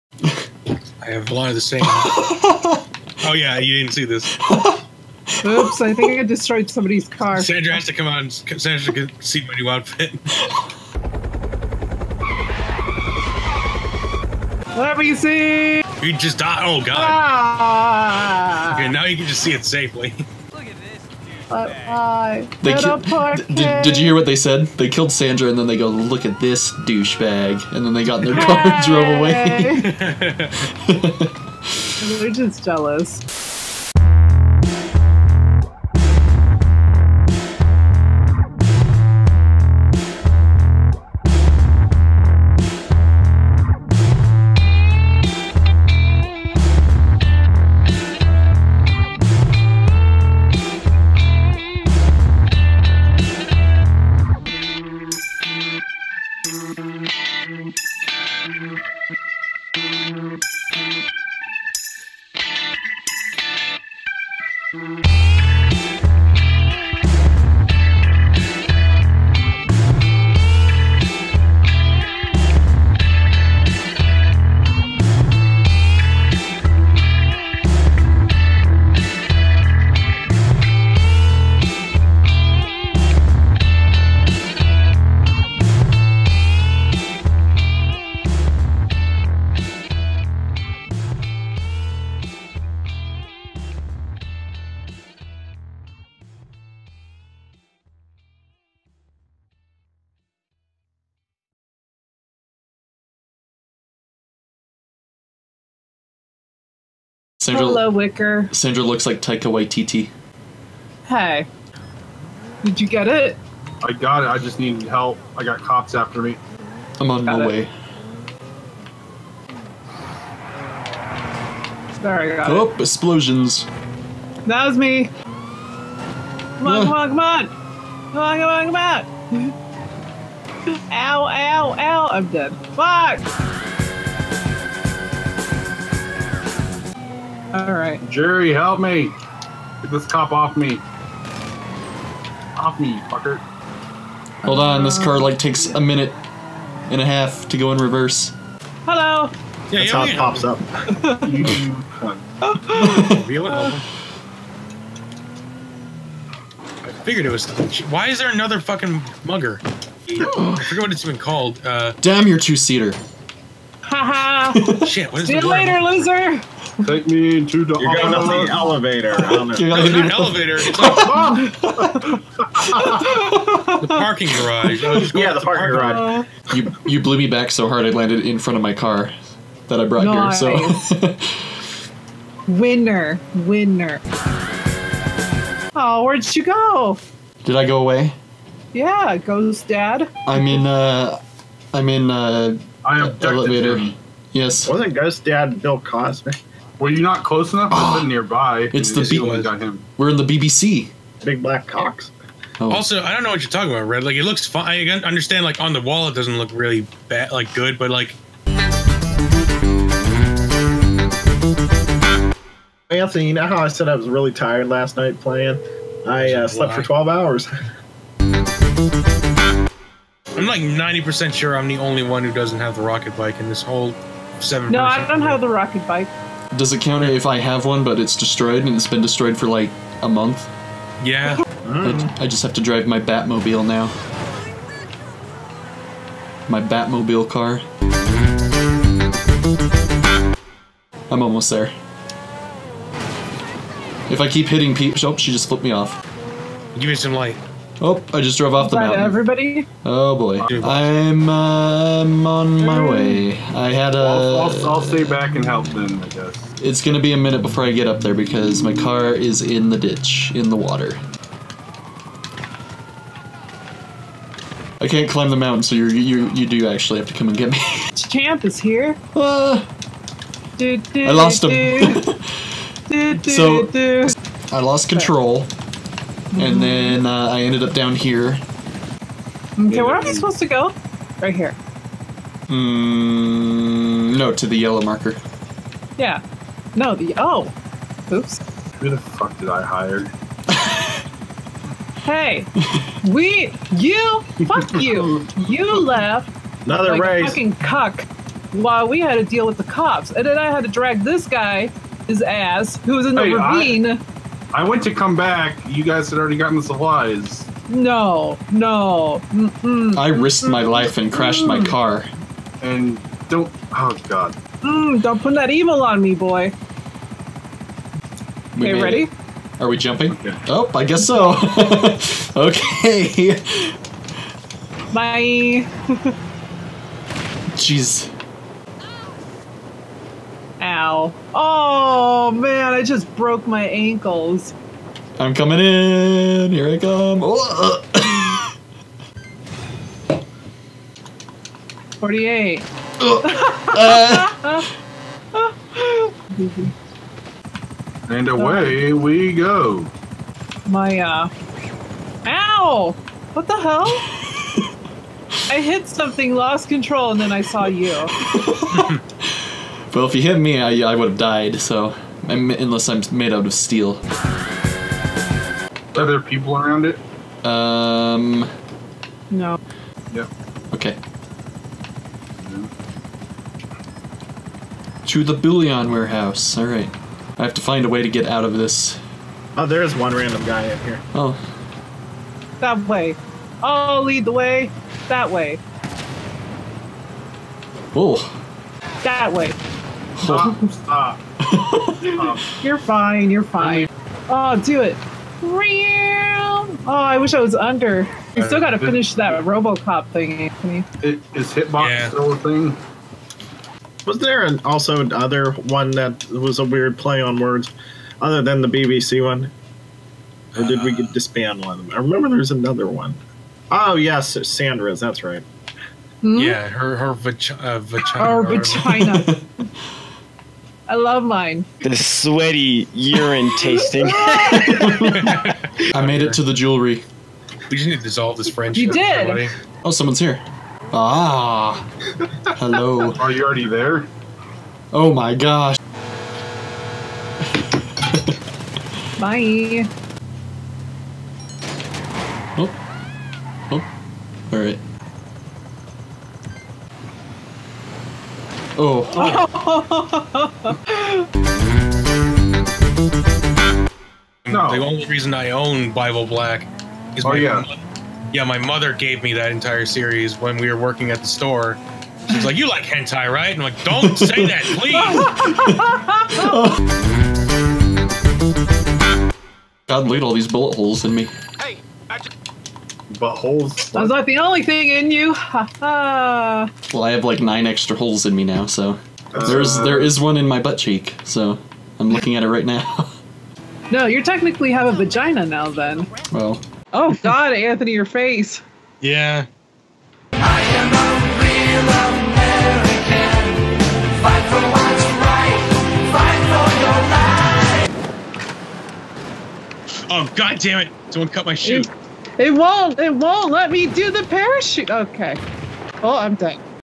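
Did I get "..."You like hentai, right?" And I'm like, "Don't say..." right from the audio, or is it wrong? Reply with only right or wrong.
right.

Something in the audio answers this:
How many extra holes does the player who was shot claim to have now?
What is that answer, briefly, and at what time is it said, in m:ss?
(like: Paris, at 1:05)
9, at 7:57.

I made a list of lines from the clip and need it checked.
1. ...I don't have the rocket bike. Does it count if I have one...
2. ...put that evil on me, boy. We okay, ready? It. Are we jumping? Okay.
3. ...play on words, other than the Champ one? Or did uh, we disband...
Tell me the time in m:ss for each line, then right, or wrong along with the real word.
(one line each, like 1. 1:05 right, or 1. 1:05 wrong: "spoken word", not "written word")
1. 3:44 right
2. 5:15 right
3. 6:46 wrong: "BBC", not "Champ".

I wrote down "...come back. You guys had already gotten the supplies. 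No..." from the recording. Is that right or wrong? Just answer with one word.
right.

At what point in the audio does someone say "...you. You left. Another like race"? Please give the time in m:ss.
4:54.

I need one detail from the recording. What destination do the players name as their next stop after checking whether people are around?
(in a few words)
bullion warehouse.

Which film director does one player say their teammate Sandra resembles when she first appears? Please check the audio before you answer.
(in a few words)
Taika Waititi.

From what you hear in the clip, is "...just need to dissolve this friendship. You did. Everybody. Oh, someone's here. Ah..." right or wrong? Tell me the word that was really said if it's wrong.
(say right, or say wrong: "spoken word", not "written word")
right.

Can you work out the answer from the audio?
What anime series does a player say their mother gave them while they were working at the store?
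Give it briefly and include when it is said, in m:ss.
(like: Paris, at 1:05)
Bible Black, at 7:35.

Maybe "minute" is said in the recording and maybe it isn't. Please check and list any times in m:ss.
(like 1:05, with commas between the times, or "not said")
2:25, 4:17.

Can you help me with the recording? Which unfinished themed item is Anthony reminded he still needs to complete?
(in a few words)
RoboCop thing.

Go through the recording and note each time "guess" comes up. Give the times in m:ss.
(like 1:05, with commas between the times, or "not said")
4:16, 5:20.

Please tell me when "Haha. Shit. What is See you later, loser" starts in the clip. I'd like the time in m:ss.
2:43.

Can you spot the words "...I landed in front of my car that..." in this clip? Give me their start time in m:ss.
2:57.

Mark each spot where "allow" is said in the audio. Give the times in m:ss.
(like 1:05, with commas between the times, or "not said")
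not said.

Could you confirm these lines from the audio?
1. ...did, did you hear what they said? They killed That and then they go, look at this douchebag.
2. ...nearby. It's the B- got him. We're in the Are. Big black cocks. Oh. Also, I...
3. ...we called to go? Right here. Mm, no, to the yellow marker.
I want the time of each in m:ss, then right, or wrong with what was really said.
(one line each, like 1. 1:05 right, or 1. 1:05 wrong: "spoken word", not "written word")
1. 0:23 wrong: "Sandra", not "That"
2. 3:18 wrong: "BBC", not "Are"
3. 4:40 wrong: "supposed", not "called".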